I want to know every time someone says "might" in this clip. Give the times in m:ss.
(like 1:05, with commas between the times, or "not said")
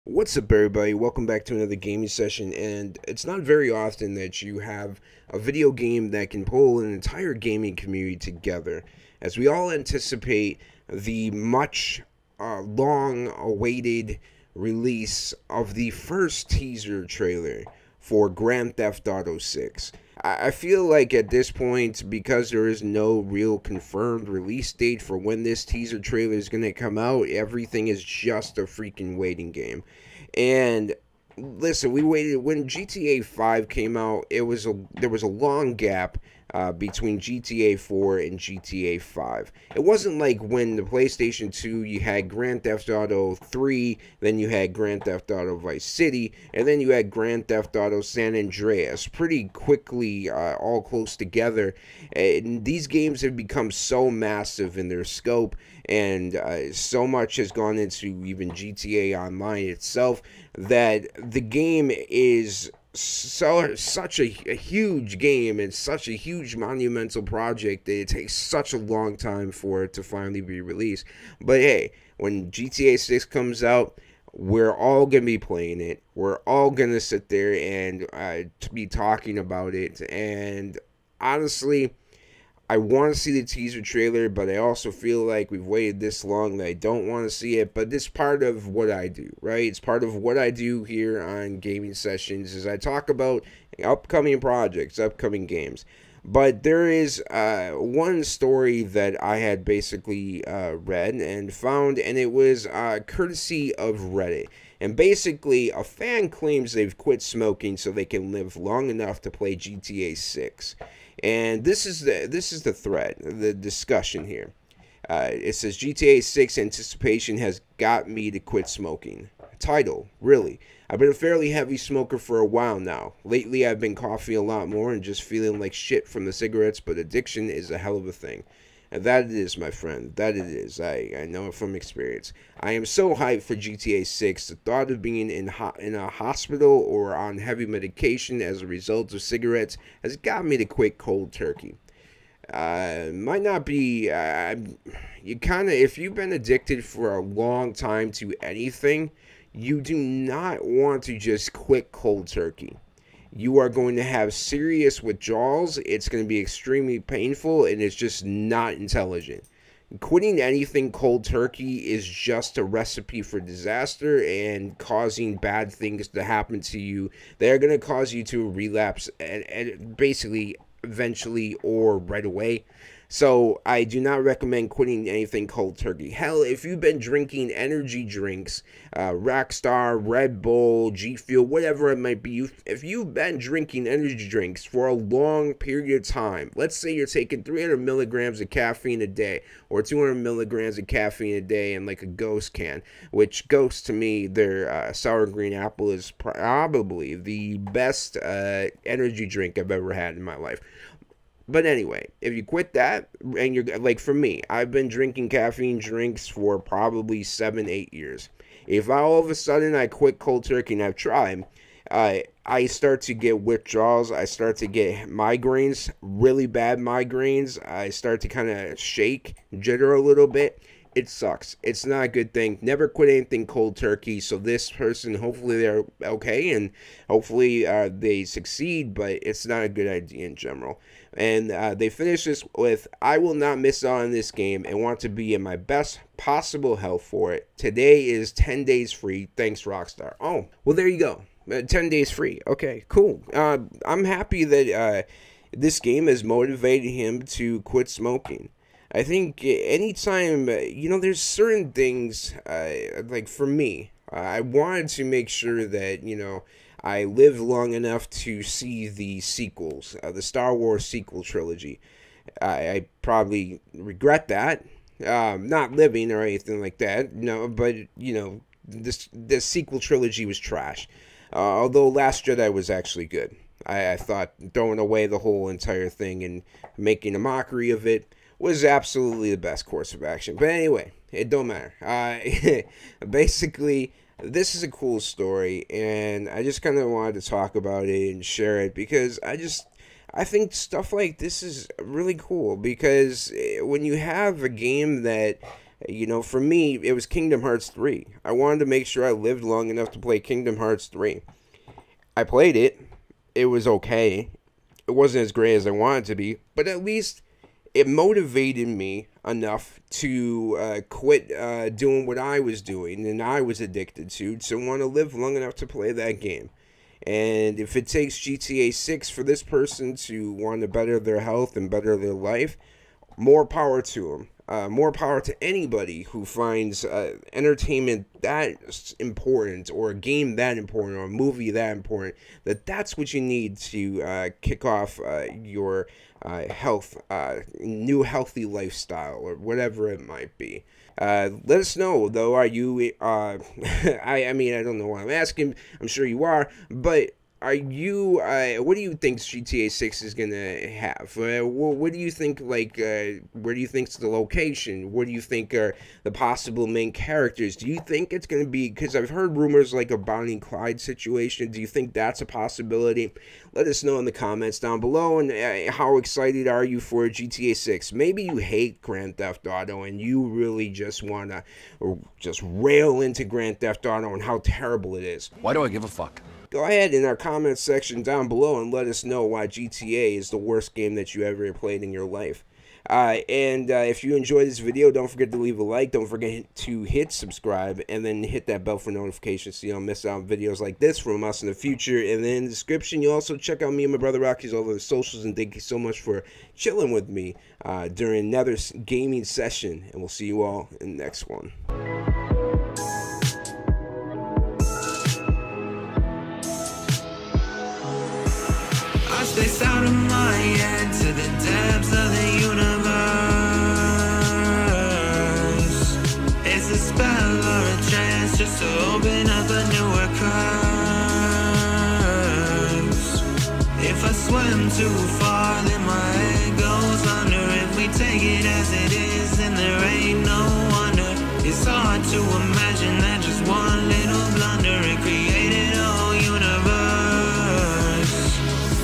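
2:23, 3:01, 5:40.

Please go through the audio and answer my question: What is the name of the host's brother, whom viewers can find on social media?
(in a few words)
Rocky.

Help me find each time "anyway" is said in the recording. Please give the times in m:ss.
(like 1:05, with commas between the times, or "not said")
3:21, 4:40.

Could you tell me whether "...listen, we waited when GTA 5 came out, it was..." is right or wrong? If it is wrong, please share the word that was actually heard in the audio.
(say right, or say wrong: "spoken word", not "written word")
right.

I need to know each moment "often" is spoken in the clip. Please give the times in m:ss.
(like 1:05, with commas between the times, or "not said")
0:03.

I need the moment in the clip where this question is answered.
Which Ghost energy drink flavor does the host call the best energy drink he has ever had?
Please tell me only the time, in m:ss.
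3:14.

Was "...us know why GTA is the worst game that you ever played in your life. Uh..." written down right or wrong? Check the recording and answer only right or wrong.
right.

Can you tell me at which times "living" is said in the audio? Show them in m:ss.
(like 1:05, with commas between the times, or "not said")
4:25.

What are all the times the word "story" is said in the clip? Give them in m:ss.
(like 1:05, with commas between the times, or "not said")
1:38, 4:44.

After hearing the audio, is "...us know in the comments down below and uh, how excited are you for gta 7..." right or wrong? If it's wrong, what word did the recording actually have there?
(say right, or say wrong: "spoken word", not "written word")
wrong: "6", not "7".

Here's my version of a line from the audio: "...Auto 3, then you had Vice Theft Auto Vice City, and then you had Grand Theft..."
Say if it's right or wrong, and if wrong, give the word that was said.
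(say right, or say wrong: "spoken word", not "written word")
wrong: "Grand", not "Vice".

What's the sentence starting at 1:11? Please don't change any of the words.
But hey, when GTA 6 comes out, we're all gonna be playing it.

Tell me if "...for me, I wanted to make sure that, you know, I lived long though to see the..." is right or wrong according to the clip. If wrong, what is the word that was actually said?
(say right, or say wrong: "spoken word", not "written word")
wrong: "enough", not "though".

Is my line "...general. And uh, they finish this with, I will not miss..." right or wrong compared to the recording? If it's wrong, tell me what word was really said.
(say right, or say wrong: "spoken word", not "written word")
right.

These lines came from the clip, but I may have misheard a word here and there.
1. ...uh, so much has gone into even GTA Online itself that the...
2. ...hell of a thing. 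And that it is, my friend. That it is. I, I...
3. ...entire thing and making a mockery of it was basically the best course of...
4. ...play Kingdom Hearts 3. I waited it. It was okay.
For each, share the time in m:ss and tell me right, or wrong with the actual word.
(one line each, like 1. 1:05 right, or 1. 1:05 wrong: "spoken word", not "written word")
1. 0:56 right
2. 2:07 right
3. 4:35 wrong: "absolutely", not "basically"
4. 4:59 wrong: "played", not "waited".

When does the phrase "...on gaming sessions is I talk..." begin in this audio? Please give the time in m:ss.
1:31.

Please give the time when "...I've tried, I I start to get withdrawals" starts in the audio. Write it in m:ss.
3:30.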